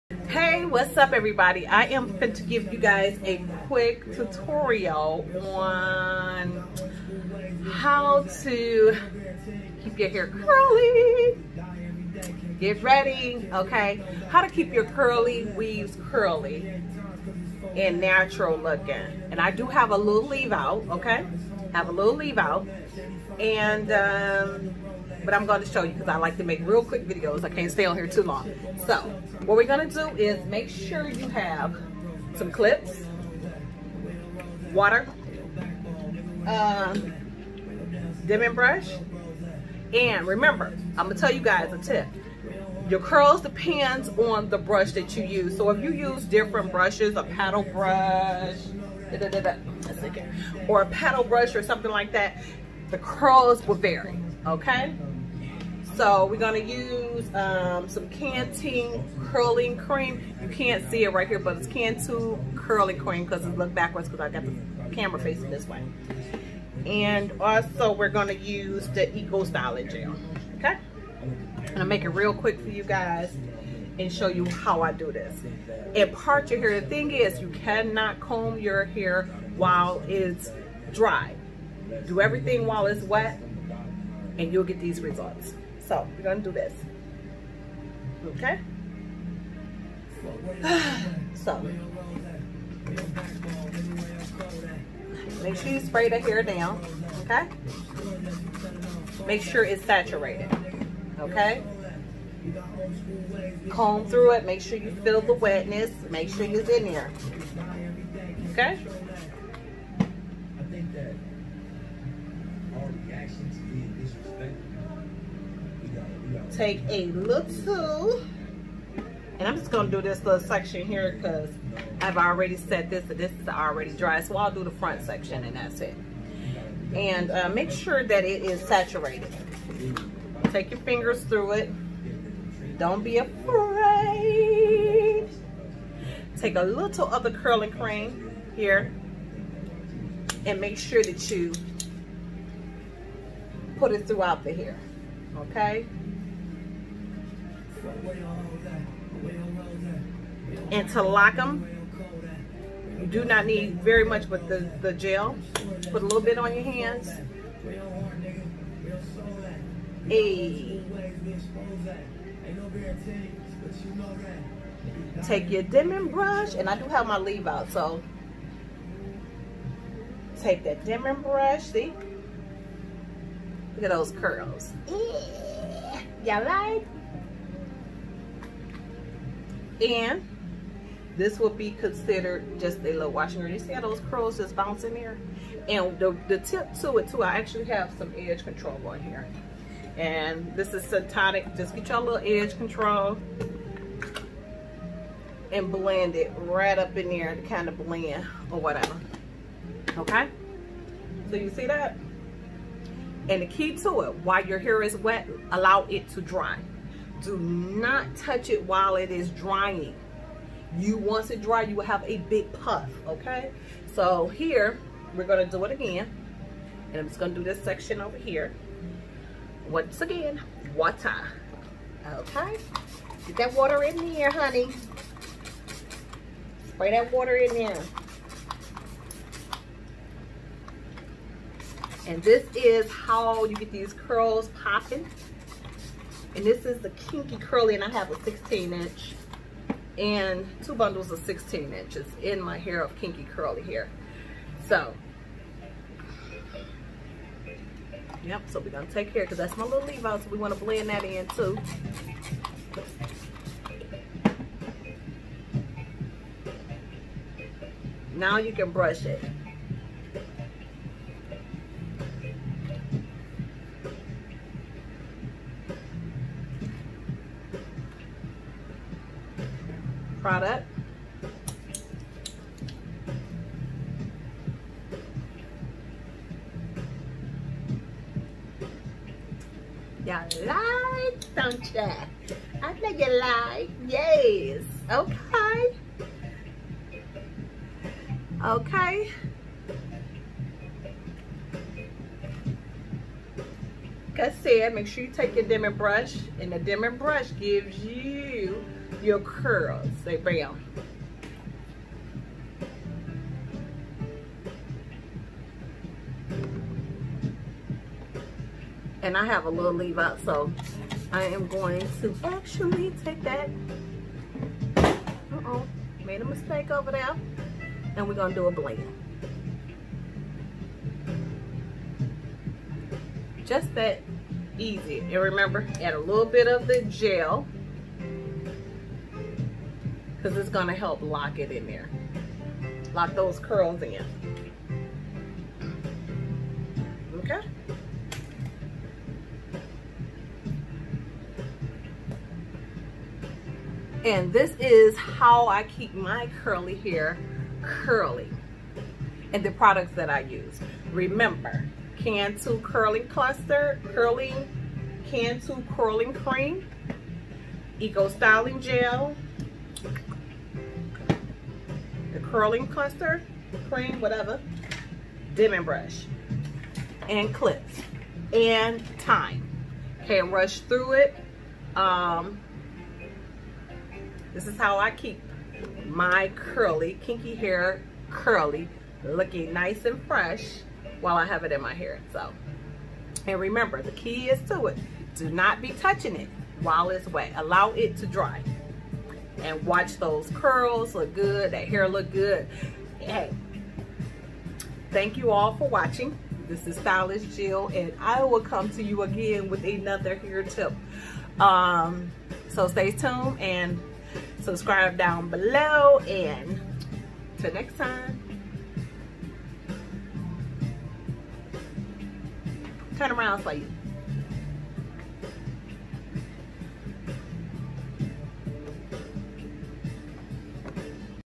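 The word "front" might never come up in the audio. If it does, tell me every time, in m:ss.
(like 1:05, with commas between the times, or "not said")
2:04.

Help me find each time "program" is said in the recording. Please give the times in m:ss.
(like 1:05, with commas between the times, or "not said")
not said.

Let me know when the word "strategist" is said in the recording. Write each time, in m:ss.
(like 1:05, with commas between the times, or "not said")
not said.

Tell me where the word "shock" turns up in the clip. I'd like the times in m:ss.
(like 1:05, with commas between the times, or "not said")
not said.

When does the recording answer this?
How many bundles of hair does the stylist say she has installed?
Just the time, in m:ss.
4:00.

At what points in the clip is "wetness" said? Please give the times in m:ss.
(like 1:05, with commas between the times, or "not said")
1:45.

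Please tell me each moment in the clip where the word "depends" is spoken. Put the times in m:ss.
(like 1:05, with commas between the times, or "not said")
0:43.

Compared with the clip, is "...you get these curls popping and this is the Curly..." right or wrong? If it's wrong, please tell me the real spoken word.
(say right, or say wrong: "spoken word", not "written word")
wrong: "Kinky", not "Curly".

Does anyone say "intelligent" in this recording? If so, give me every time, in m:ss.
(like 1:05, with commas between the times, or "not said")
not said.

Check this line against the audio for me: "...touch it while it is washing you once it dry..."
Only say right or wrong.
wrong.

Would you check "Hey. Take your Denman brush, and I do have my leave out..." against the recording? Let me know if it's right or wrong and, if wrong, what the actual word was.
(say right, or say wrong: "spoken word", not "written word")
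right.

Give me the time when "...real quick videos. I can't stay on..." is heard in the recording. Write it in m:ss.
0:26.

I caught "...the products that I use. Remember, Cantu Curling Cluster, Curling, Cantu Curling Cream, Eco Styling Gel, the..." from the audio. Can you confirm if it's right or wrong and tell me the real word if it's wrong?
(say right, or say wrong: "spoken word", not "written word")
right.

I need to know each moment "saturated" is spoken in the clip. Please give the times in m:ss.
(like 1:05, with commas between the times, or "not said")
1:39, 2:08.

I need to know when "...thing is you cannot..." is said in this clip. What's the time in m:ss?
1:16.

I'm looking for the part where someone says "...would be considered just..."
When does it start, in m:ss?
3:01.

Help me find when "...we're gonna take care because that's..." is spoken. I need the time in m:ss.
4:08.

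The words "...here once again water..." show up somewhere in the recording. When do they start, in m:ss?
3:38.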